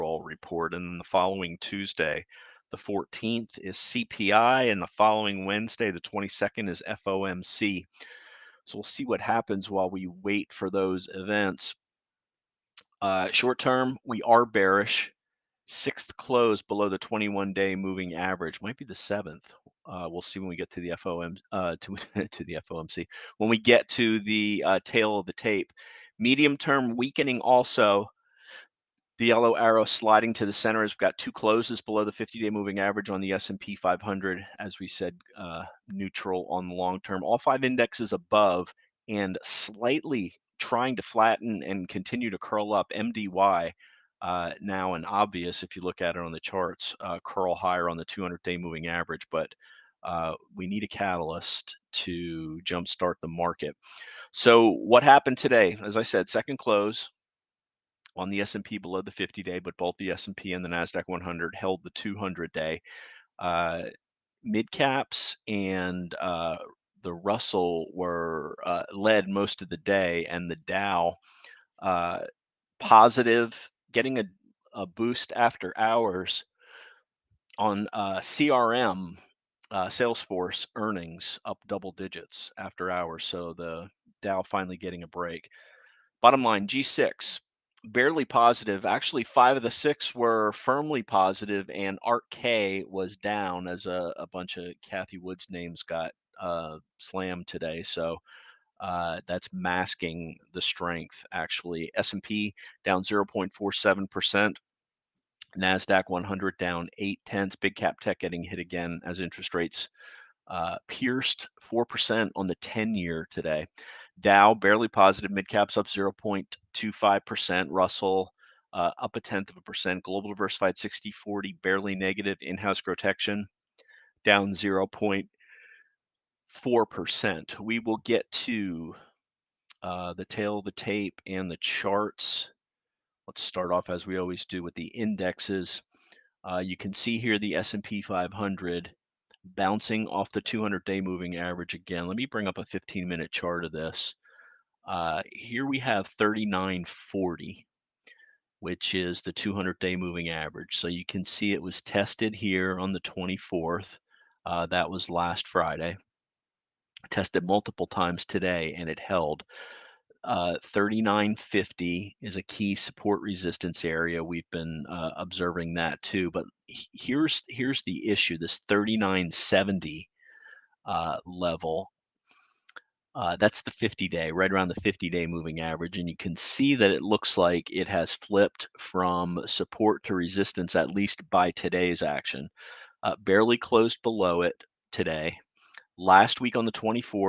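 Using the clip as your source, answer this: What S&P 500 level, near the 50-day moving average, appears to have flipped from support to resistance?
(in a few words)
3970.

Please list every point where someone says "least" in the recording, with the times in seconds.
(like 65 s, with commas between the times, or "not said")
180 s.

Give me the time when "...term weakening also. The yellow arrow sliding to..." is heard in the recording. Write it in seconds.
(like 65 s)
26 s.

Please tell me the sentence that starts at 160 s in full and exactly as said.
Uh, 3950 is a key support resistance area.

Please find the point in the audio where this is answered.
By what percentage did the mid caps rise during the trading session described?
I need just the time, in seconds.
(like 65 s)
115 s.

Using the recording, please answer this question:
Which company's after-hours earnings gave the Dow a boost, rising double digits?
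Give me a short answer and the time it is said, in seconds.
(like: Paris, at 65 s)
Salesforce, at 79 s.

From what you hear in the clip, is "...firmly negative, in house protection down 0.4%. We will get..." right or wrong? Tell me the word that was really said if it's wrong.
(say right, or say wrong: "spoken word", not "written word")
wrong: "barely", not "firmly".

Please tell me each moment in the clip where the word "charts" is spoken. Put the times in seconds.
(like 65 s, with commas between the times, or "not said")
46 s, 131 s, 143 s.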